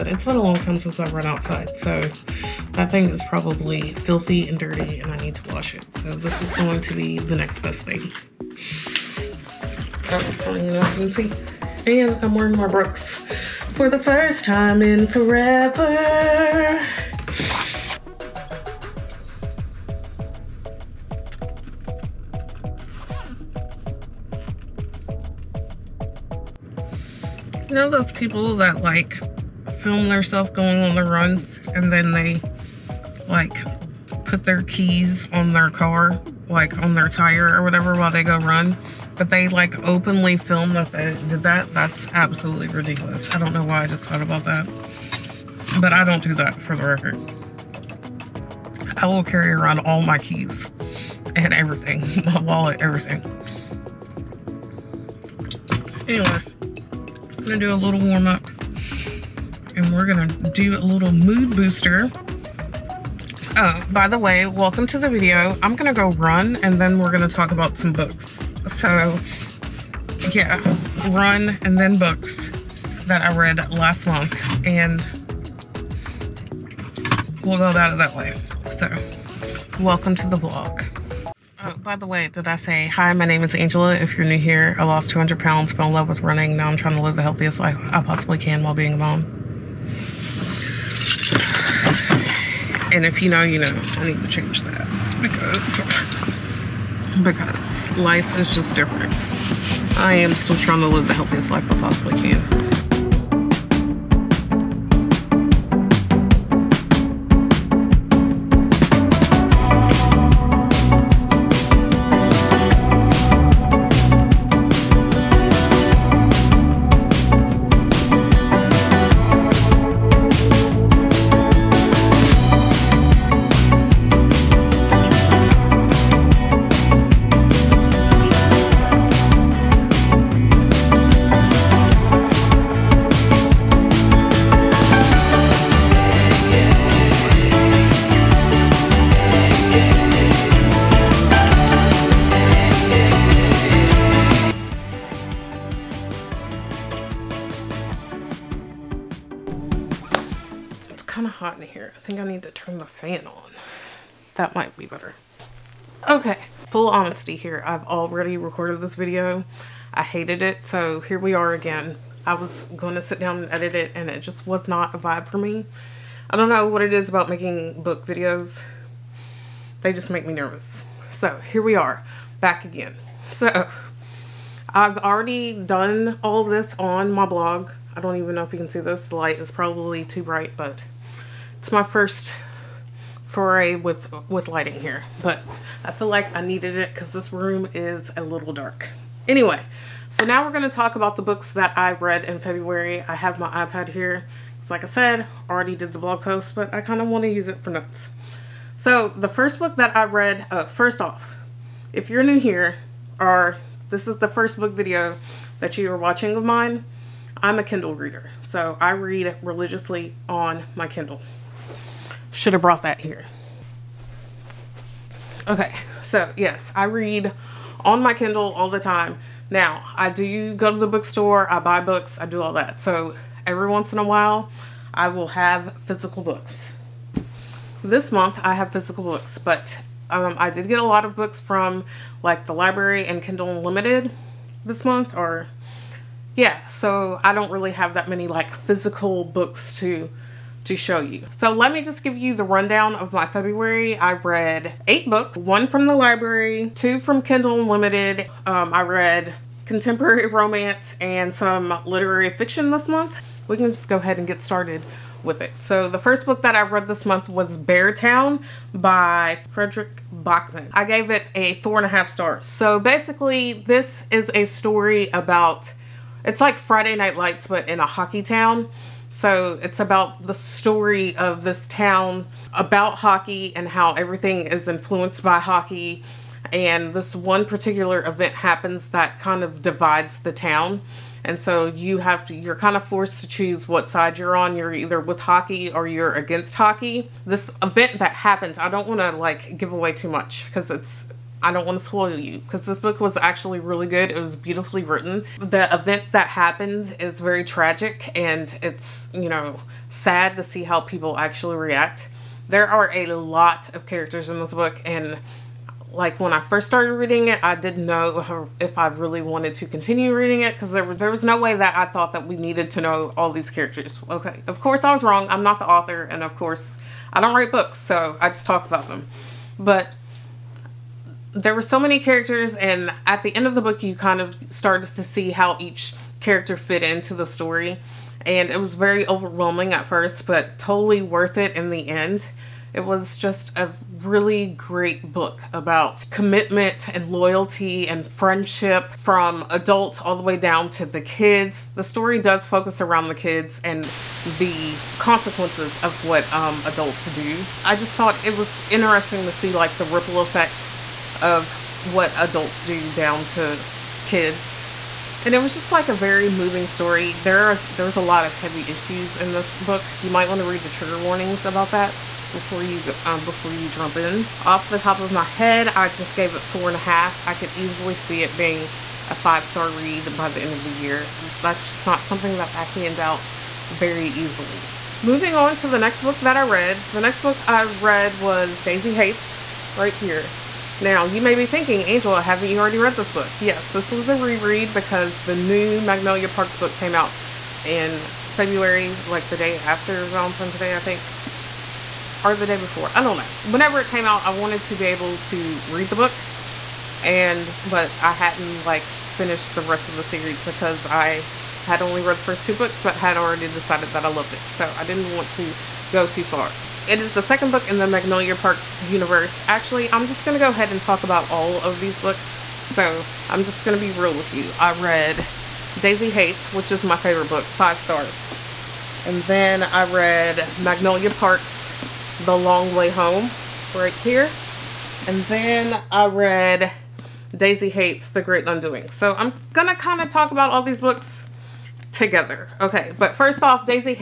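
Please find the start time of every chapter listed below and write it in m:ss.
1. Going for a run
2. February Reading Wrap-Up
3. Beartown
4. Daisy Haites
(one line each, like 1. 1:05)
1. 0:30
2. 2:25
3. 4:18
4. 6:22.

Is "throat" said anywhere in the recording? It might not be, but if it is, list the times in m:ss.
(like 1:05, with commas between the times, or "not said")
not said.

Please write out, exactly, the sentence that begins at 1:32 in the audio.
And if you know, you know, I need to change that because, because life is just different.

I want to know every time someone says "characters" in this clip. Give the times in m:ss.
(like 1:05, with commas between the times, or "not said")
5:03, 5:13, 5:21, 5:26.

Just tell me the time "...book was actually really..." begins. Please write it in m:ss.
4:52.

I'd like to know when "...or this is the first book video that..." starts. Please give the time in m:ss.
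3:23.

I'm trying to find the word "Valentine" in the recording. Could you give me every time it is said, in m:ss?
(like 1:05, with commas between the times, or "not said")
6:30.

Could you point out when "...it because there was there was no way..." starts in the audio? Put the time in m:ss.
5:10.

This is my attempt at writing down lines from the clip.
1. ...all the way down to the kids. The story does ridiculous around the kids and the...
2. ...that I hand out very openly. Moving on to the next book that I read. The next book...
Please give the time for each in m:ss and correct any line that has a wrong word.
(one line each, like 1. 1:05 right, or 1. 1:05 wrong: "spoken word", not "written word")
1. 5:40 wrong: "focus", not "ridiculous"
2. 6:12 wrong: "easily", not "openly".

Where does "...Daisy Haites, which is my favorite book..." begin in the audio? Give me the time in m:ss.
6:55.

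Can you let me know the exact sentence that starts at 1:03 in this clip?
Oh, by the way, welcome to the video.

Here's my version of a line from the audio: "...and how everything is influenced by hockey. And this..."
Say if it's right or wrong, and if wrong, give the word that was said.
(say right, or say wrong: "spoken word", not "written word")
right.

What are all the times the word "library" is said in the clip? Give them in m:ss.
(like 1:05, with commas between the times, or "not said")
3:52, 4:05.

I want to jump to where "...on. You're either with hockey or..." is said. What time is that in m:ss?
4:44.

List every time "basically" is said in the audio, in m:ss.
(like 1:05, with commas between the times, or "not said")
4:22.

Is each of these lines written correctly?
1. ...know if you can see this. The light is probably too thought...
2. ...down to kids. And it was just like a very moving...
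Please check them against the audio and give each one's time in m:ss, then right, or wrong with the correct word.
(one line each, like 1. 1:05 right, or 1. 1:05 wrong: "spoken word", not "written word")
1. 2:58 wrong: "bright", not "thought"
2. 5:52 right.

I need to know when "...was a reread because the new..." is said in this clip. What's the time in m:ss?
6:23.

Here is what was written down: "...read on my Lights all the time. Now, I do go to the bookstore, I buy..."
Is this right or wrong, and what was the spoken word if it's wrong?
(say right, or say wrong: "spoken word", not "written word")
wrong: "Kindle", not "Lights".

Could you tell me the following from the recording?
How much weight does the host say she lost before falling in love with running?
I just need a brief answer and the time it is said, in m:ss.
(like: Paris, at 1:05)
200 pounds, at 1:25.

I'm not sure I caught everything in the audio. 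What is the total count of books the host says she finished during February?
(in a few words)
8.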